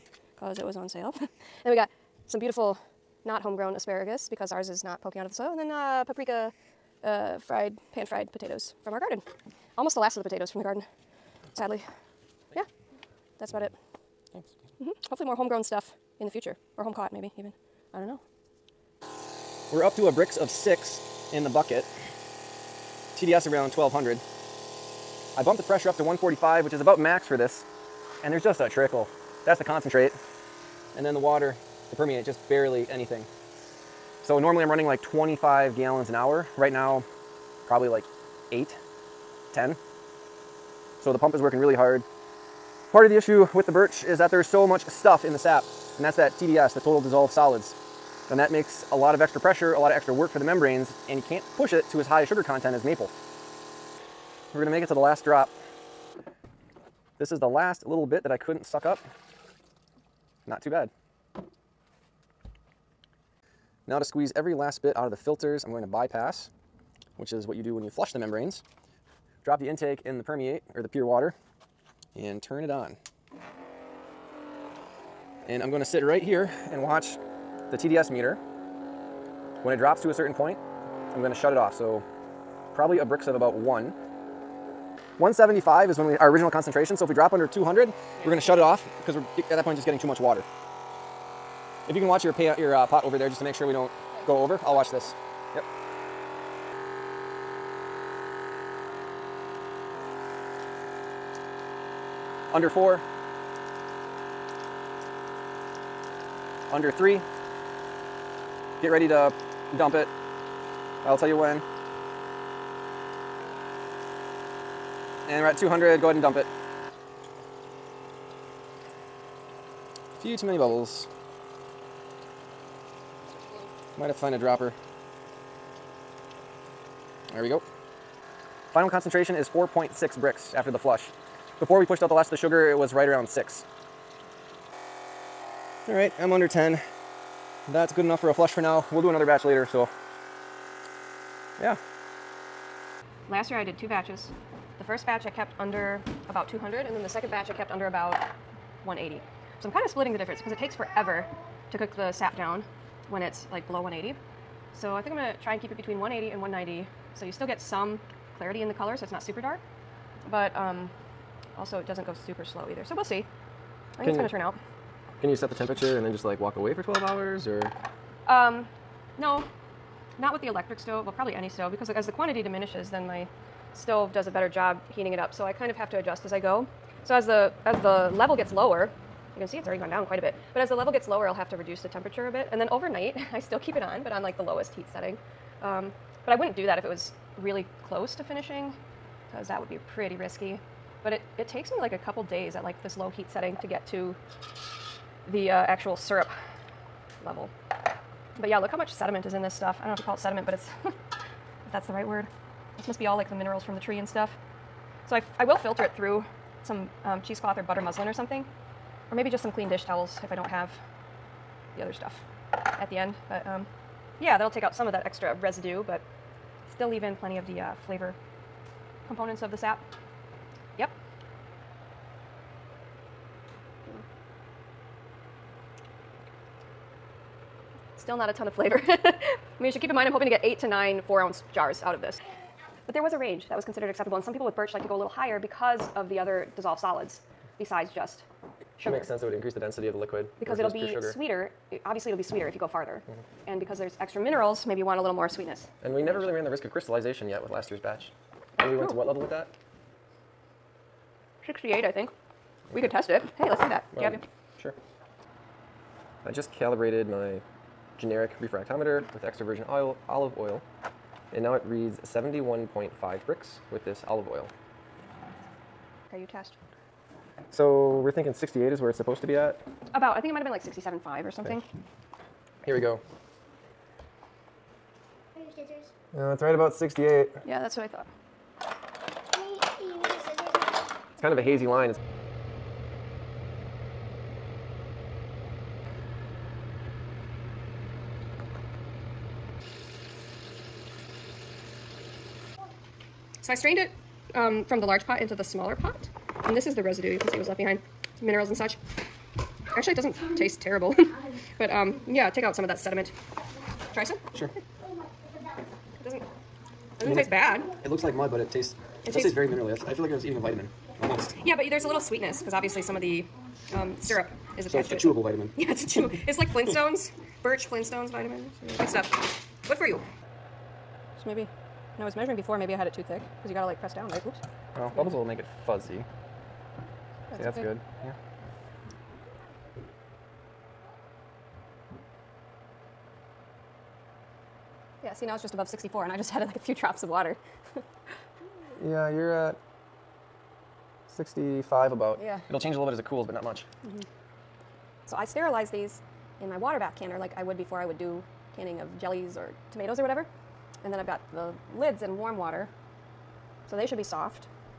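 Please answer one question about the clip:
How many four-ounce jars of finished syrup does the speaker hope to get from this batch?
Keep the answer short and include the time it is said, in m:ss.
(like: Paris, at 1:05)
8 to 9, at 3:50.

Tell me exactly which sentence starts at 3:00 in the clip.
But as the level gets lower, I'll have to reduce the temperature a bit.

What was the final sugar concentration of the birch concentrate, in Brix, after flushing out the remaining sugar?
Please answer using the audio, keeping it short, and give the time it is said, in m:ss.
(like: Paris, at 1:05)
4.6 Brix, at 2:09.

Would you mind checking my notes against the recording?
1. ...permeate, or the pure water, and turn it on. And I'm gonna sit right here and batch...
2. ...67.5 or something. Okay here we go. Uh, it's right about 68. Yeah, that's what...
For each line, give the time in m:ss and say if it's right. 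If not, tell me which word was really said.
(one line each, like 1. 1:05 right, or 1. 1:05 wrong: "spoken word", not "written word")
1. 1:10 wrong: "watch", not "batch"
2. 4:30 right.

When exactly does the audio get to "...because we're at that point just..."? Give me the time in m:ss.
1:29.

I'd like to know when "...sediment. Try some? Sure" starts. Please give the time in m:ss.
5:02.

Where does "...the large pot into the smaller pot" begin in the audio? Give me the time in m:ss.
4:54.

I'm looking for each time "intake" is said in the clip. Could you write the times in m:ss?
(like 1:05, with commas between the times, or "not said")
1:09.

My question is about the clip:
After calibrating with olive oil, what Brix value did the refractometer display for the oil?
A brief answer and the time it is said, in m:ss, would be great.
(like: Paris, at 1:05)
71.5, at 4:22.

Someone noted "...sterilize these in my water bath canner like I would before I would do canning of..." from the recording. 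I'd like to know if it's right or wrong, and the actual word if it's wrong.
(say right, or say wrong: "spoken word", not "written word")
right.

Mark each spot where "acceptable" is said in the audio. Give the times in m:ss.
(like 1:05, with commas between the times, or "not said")
3:53.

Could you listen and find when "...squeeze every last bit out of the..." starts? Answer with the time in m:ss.
1:04.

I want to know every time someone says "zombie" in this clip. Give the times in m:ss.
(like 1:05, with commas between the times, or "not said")
not said.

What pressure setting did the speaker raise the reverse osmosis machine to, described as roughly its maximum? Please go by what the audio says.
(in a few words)
145.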